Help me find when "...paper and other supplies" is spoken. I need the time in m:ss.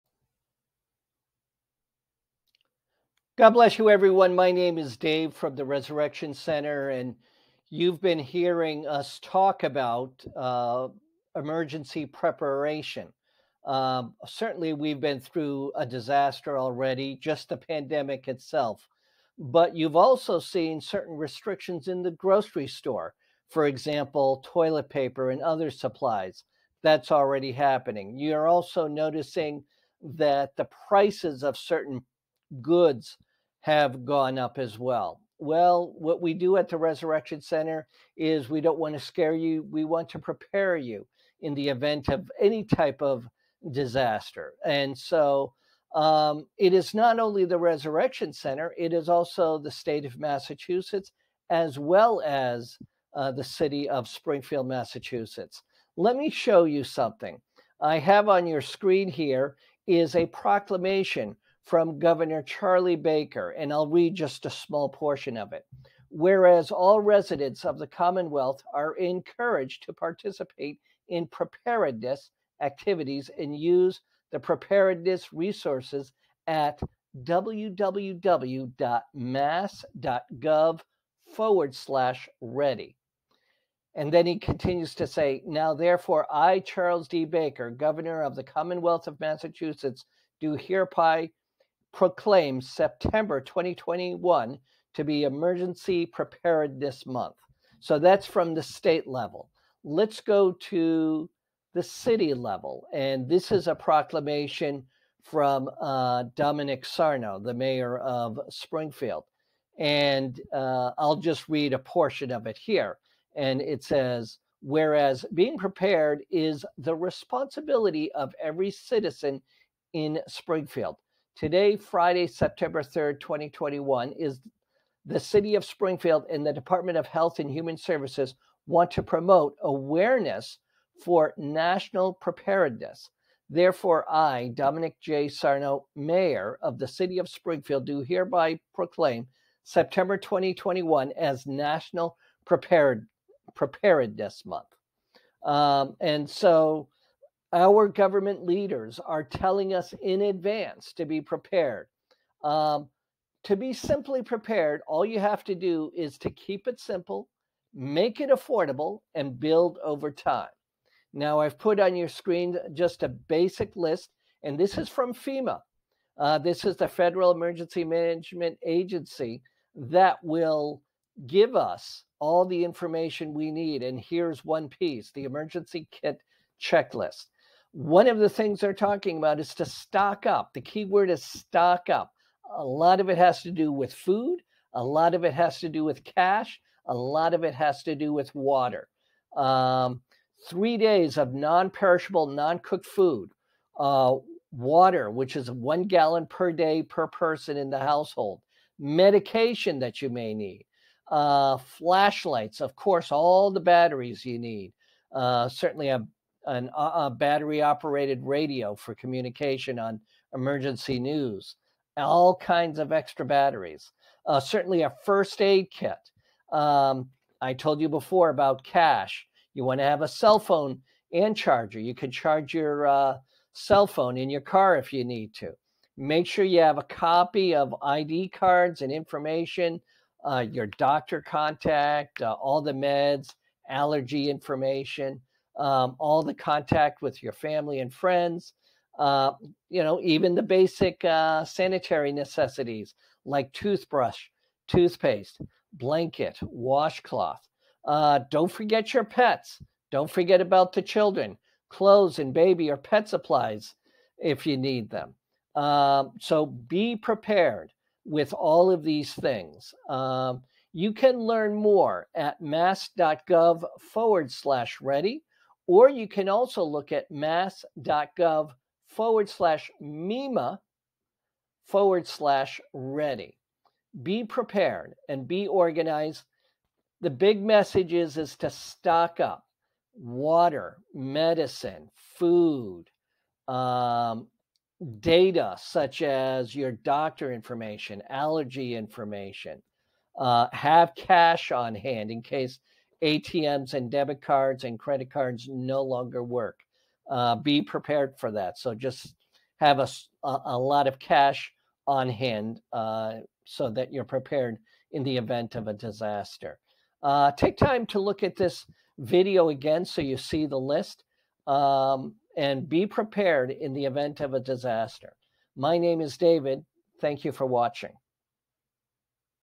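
0:24.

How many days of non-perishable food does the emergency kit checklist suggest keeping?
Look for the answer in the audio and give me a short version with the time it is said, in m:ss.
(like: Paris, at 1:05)
3 days, at 3:10.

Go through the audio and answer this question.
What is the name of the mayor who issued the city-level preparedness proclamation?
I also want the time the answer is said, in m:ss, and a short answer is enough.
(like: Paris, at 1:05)
Domenic Sarno, at 1:46.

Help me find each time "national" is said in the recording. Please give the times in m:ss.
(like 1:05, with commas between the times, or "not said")
2:11, 2:21.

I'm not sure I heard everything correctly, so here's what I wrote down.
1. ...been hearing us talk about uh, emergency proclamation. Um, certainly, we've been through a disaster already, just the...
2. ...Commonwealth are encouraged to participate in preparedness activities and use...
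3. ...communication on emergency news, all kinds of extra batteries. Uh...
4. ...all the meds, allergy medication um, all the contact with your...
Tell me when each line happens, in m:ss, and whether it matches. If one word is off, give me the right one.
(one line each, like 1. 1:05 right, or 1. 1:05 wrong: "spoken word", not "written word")
1. 0:07 wrong: "preparation", not "proclamation"
2. 1:07 right
3. 3:28 right
4. 3:52 wrong: "information", not "medication".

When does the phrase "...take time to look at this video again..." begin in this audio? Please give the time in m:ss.
5:07.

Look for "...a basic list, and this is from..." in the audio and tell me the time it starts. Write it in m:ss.
2:43.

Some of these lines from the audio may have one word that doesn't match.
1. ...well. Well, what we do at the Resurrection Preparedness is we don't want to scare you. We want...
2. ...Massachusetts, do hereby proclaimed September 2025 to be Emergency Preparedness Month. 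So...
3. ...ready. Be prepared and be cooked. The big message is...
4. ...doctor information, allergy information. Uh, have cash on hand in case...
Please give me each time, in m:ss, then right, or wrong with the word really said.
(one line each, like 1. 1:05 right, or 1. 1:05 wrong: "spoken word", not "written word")
1. 0:34 wrong: "Center", not "Preparedness"
2. 1:29 wrong: "2021", not "2025"
3. 4:32 wrong: "organized", not "cooked"
4. 4:46 right.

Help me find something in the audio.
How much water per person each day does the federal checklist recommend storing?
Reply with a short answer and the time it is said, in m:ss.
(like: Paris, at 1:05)
1 gallon, at 3:15.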